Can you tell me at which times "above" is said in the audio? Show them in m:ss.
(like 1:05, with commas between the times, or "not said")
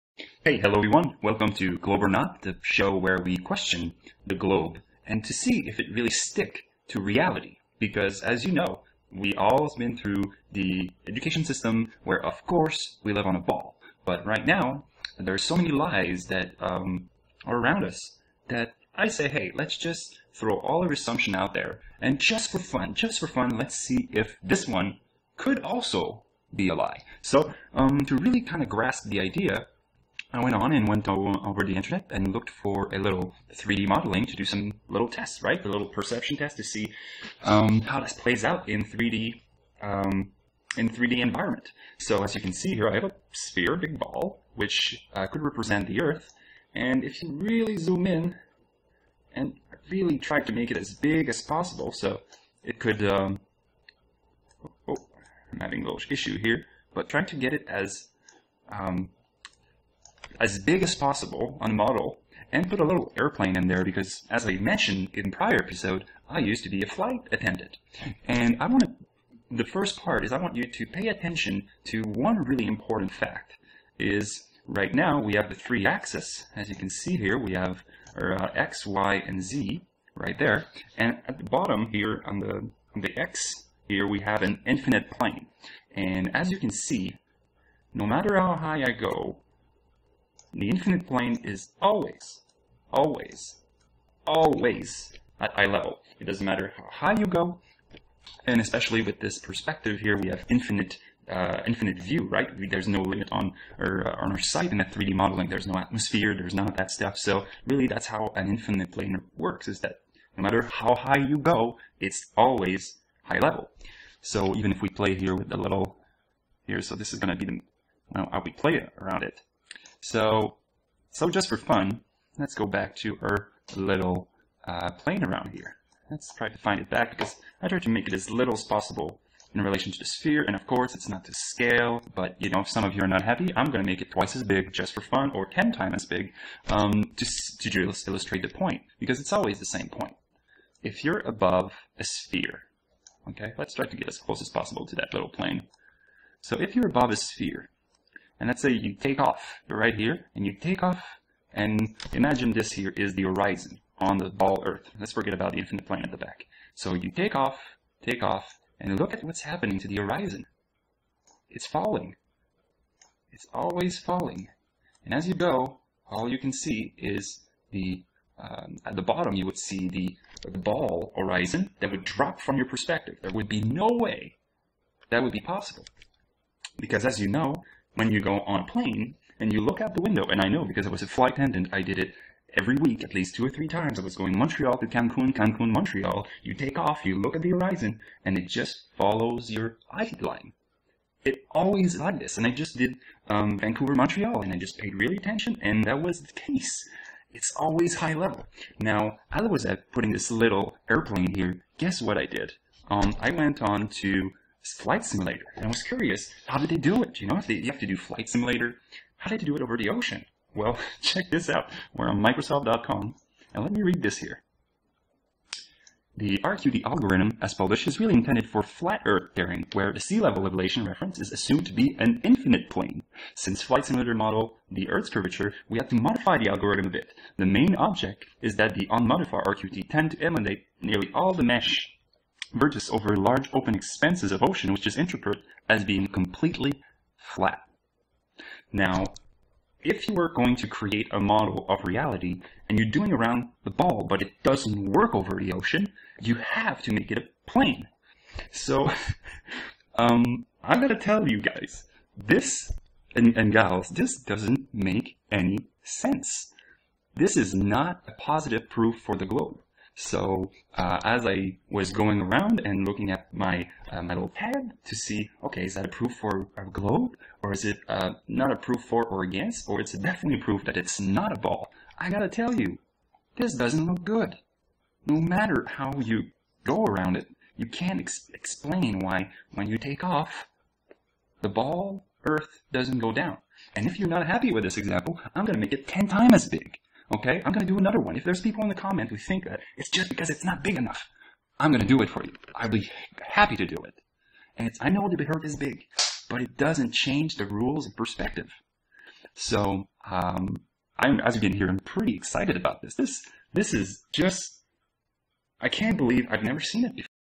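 2:21, 2:26.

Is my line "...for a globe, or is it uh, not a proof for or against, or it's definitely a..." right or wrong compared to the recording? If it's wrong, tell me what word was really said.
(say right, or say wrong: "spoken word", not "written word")
right.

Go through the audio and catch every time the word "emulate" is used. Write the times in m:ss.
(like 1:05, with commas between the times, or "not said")
3:50.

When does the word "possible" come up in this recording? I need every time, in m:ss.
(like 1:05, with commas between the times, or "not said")
0:51, 1:00, 2:08, 2:24, 2:55.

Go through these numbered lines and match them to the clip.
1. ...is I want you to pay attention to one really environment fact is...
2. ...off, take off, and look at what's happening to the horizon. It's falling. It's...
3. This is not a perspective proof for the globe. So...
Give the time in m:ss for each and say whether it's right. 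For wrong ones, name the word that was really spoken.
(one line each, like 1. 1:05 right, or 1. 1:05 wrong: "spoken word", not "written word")
1. 1:10 wrong: "important", not "environment"
2. 2:37 right
3. 4:17 wrong: "positive", not "perspective".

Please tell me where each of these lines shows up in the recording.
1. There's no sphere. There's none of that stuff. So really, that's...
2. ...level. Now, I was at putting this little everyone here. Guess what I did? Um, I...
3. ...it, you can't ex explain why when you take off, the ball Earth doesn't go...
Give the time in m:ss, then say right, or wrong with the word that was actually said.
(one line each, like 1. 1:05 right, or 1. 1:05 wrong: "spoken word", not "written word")
1. 1:45 wrong: "atmosphere", not "sphere"
2. 3:18 wrong: "airplane", not "everyone"
3. 4:37 right.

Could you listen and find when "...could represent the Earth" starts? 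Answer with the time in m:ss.
0:45.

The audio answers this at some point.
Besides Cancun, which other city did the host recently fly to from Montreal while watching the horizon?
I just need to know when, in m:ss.
3:13.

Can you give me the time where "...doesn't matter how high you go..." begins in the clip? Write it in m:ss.
1:36.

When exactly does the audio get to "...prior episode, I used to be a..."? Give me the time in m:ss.
1:05.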